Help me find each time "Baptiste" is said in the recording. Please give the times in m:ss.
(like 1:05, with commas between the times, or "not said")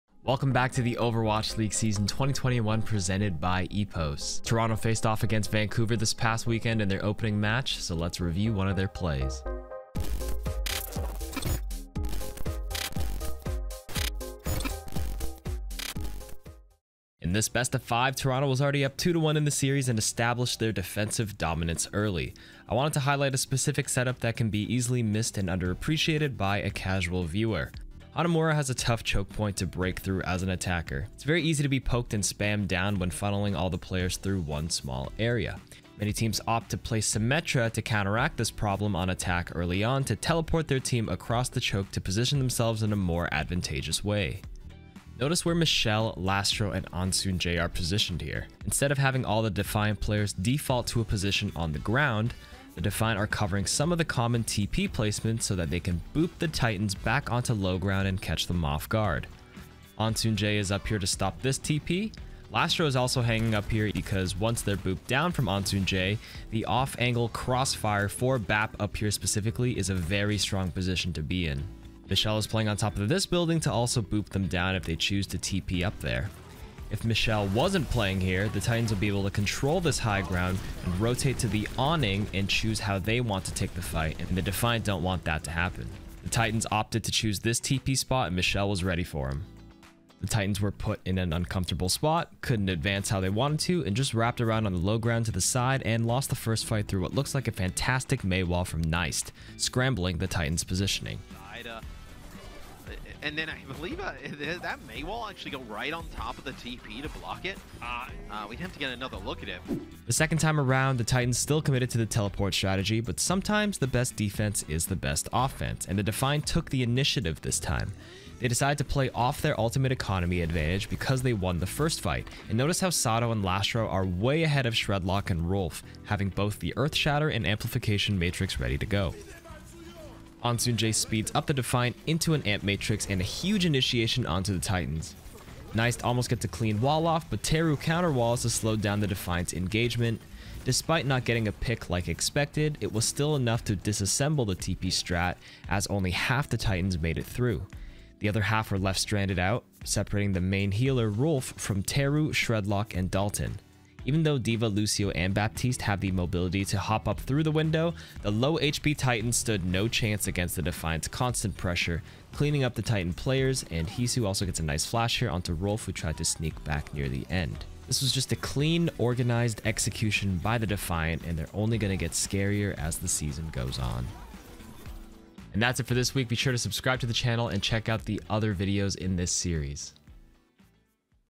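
2:35.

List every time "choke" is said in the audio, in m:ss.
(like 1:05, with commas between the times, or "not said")
0:29, 0:41.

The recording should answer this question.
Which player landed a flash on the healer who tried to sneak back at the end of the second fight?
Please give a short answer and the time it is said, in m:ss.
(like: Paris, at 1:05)
Heesu, at 2:43.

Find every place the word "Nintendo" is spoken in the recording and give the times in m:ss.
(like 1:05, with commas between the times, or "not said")
not said.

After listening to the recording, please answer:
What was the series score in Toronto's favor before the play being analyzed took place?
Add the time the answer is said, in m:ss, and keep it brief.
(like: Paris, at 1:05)
2 to 1, at 0:18.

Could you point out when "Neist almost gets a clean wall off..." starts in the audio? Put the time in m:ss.
2:15.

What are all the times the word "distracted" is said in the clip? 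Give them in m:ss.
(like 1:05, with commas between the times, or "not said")
not said.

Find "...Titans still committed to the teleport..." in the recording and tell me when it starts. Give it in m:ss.
1:51.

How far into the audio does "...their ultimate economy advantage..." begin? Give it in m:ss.
1:59.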